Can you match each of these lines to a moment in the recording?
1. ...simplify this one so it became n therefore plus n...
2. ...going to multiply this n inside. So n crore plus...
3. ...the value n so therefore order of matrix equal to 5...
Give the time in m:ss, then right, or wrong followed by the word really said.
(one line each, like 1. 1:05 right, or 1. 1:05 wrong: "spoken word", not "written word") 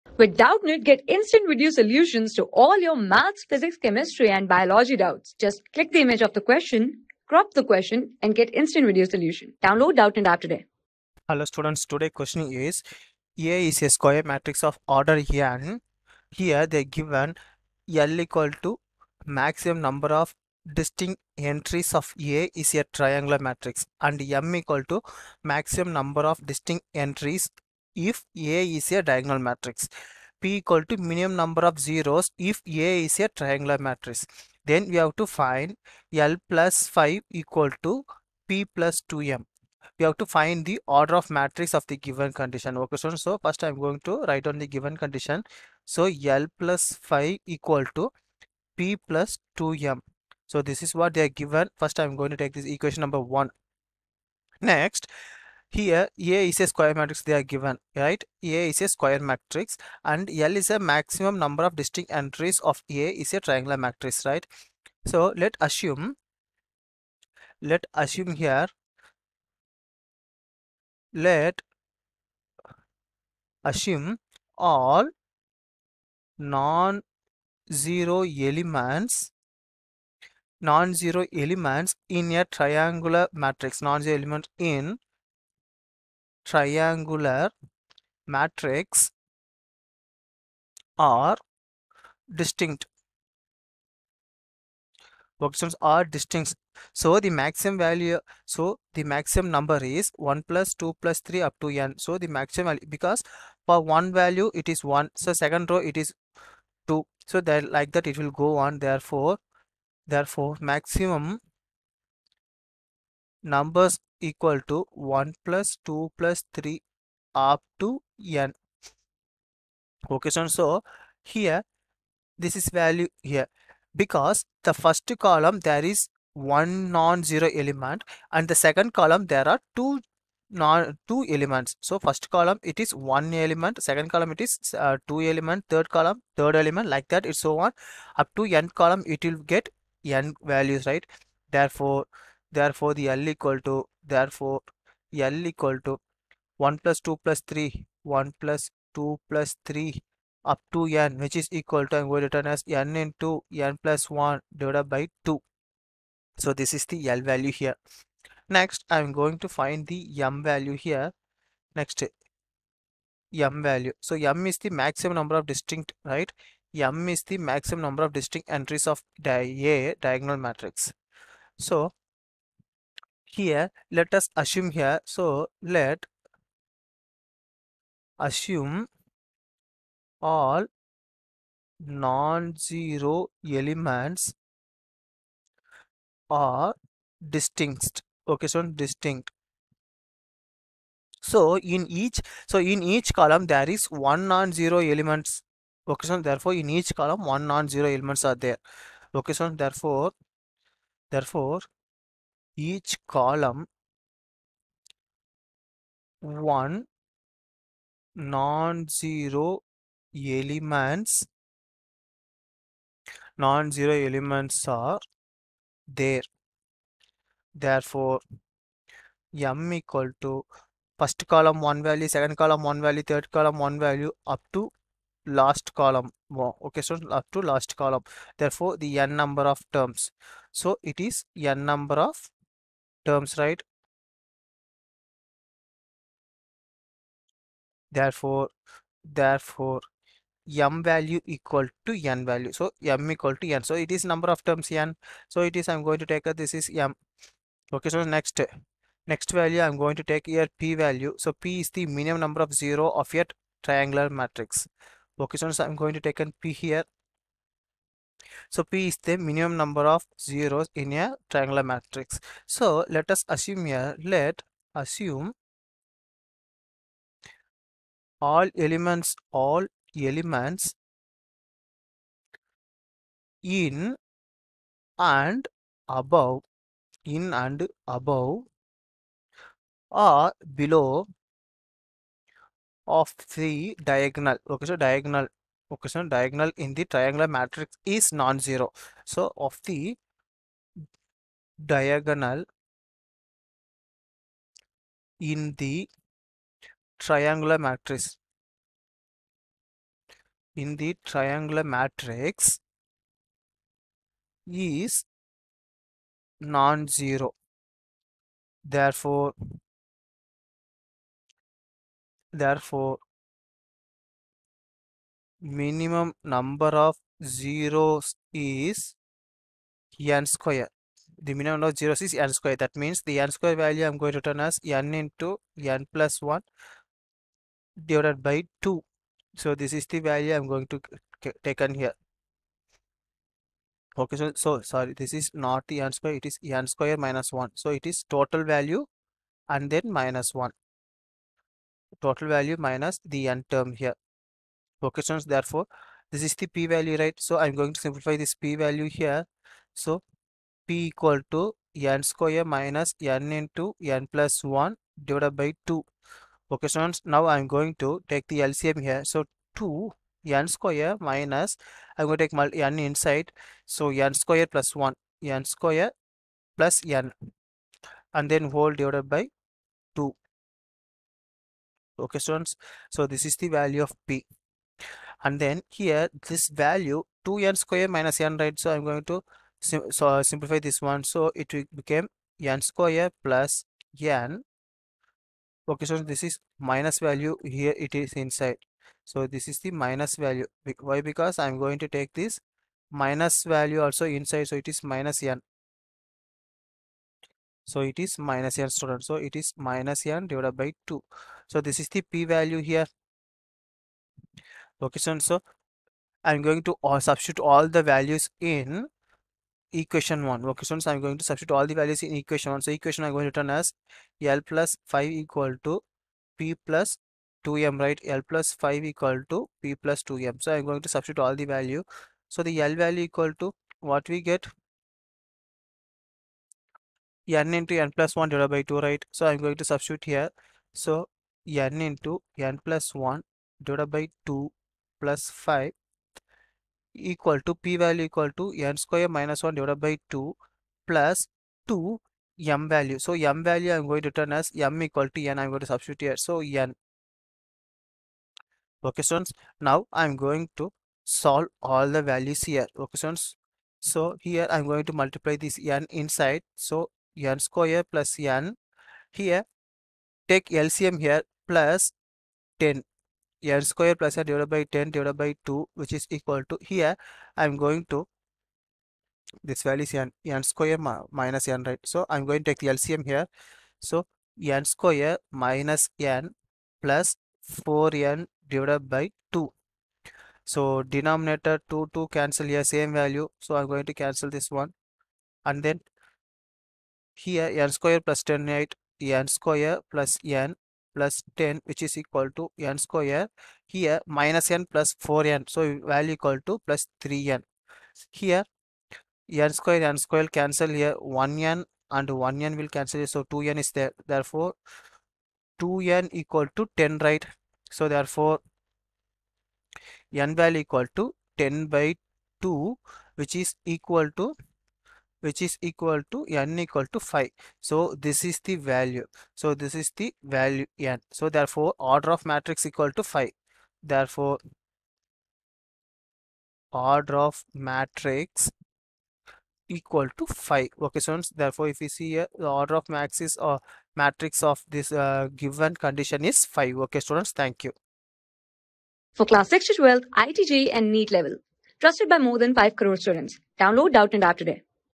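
1. 6:20 wrong: "square", not "therefore"
2. 7:34 wrong: "square", not "crore"
3. 8:39 right.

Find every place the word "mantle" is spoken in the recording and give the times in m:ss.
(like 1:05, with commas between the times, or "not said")
not said.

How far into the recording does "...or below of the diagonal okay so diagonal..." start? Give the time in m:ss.
4:39.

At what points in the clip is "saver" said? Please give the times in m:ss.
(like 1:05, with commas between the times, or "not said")
not said.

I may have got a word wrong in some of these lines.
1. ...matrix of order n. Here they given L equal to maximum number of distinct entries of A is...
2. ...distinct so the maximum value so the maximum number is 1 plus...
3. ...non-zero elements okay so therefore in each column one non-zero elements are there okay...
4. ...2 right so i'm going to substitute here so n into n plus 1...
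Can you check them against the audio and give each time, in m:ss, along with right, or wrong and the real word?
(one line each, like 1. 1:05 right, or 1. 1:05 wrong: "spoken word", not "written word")
1. 0:14 right
2. 1:36 right
3. 3:14 right
4. 7:08 right.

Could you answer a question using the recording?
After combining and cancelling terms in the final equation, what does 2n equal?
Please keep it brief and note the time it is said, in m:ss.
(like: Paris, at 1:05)
10, at 8:25.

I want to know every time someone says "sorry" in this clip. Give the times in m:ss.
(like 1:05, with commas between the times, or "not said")
5:34.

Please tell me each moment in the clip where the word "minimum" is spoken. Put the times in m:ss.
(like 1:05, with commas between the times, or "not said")
0:30, 4:11, 4:19, 5:15, 5:21.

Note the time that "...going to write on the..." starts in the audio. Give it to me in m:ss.
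0:43.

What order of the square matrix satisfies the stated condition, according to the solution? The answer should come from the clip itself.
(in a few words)
5.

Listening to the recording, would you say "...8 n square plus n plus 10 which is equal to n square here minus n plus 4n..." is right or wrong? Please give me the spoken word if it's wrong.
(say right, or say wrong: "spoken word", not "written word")
right.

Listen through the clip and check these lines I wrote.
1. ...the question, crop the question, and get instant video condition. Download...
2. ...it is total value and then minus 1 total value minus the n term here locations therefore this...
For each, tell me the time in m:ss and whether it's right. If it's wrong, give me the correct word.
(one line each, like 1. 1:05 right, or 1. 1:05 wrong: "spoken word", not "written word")
1. 0:06 wrong: "solution", not "condition"
2. 5:37 right.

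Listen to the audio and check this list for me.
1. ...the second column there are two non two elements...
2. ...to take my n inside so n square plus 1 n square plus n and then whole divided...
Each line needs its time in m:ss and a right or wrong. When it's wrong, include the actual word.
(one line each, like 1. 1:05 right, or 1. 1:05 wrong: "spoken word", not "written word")
1. 2:08 right
2. 6:02 right.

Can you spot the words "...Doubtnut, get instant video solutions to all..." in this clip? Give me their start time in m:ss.
0:00.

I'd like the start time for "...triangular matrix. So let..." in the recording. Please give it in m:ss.
4:21.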